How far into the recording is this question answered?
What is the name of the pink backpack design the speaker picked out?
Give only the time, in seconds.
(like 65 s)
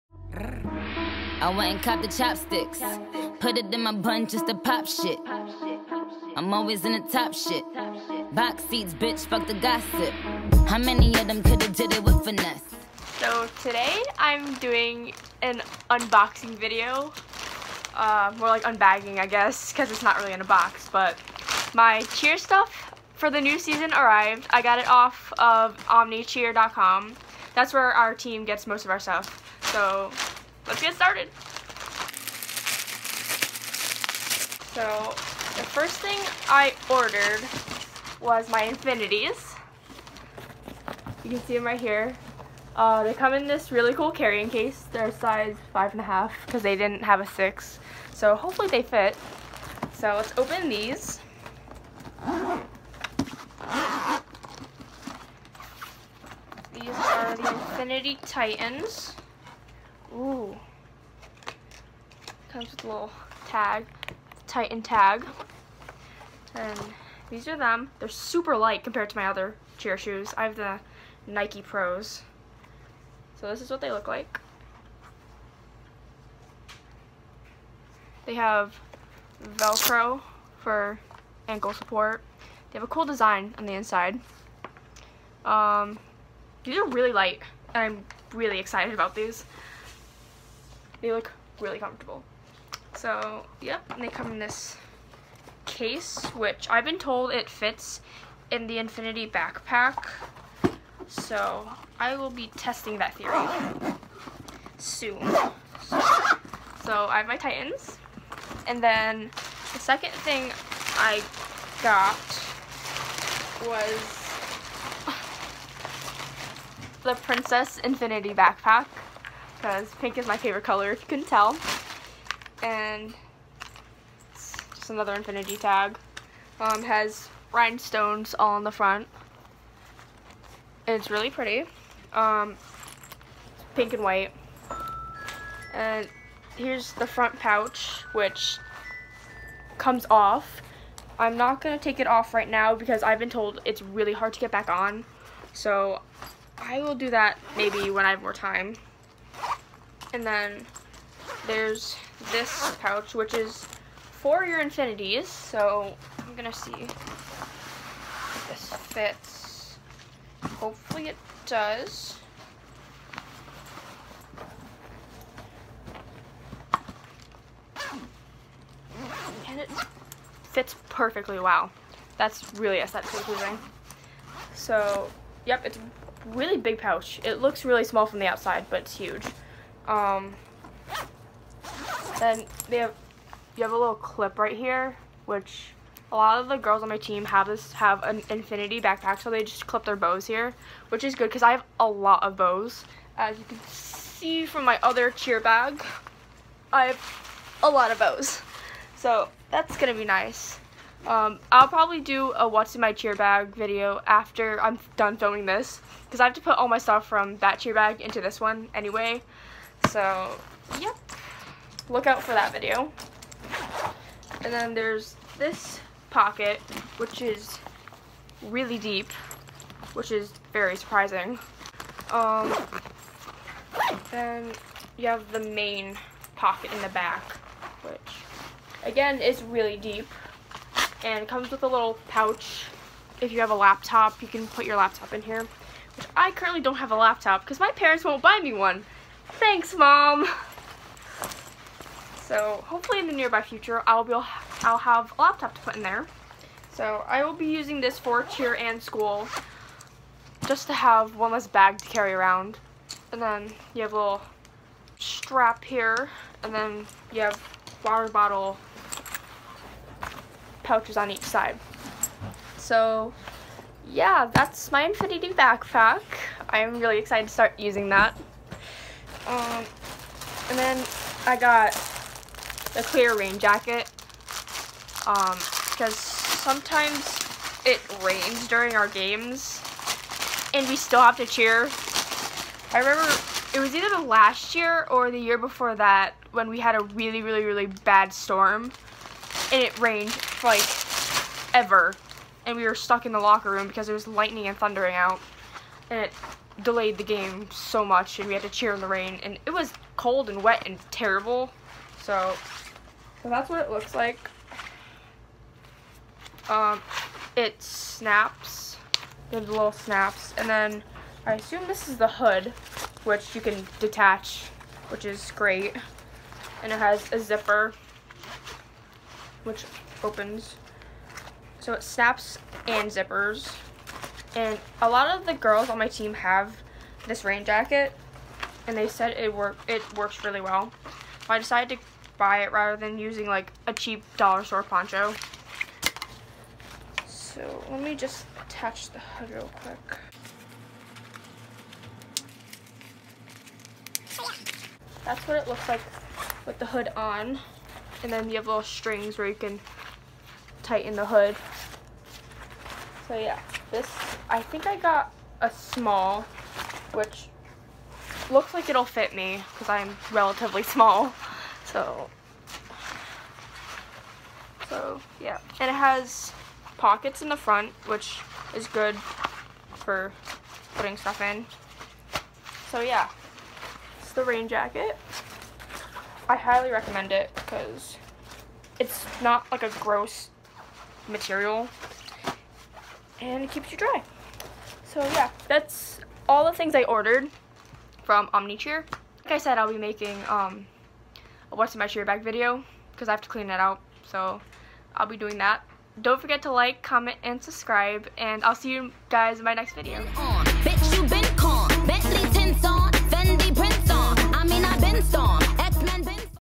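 117 s.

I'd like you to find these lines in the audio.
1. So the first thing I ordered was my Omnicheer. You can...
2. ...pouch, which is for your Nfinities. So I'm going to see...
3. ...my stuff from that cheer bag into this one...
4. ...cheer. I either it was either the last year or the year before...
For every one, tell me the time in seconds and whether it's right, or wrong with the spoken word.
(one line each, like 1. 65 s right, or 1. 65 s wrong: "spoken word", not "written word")
1. 34 s wrong: "Nfinities", not "Omnicheer"
2. 152 s right
3. 206 s right
4. 281 s wrong: "remember", not "either".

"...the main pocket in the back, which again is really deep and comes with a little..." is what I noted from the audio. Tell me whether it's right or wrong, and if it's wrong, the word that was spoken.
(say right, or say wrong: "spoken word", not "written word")
right.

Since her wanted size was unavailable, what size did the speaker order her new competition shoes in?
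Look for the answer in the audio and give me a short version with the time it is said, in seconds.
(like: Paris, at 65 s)
5.5, at 45 s.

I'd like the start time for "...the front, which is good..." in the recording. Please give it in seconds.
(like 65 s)
367 s.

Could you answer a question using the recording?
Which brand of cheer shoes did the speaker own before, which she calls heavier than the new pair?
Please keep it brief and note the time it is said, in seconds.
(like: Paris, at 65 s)
Nike Pros, at 71 s.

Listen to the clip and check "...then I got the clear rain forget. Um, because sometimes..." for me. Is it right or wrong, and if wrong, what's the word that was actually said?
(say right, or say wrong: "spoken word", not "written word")
wrong: "jacket", not "forget".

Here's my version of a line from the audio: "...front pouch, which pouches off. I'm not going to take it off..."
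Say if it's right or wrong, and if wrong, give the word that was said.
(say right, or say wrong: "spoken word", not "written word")
wrong: "comes", not "pouches".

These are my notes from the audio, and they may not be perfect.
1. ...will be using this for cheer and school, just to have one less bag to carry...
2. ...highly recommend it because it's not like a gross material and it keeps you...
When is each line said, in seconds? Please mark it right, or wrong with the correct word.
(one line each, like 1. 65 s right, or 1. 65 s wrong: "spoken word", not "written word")
1. 247 s right
2. 376 s right.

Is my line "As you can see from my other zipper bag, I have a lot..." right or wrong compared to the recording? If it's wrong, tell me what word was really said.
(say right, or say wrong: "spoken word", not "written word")
wrong: "cheer", not "zipper".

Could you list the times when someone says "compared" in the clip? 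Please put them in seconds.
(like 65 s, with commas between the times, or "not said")
68 s.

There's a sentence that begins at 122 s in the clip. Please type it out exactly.
And it's just another Nfinity tag.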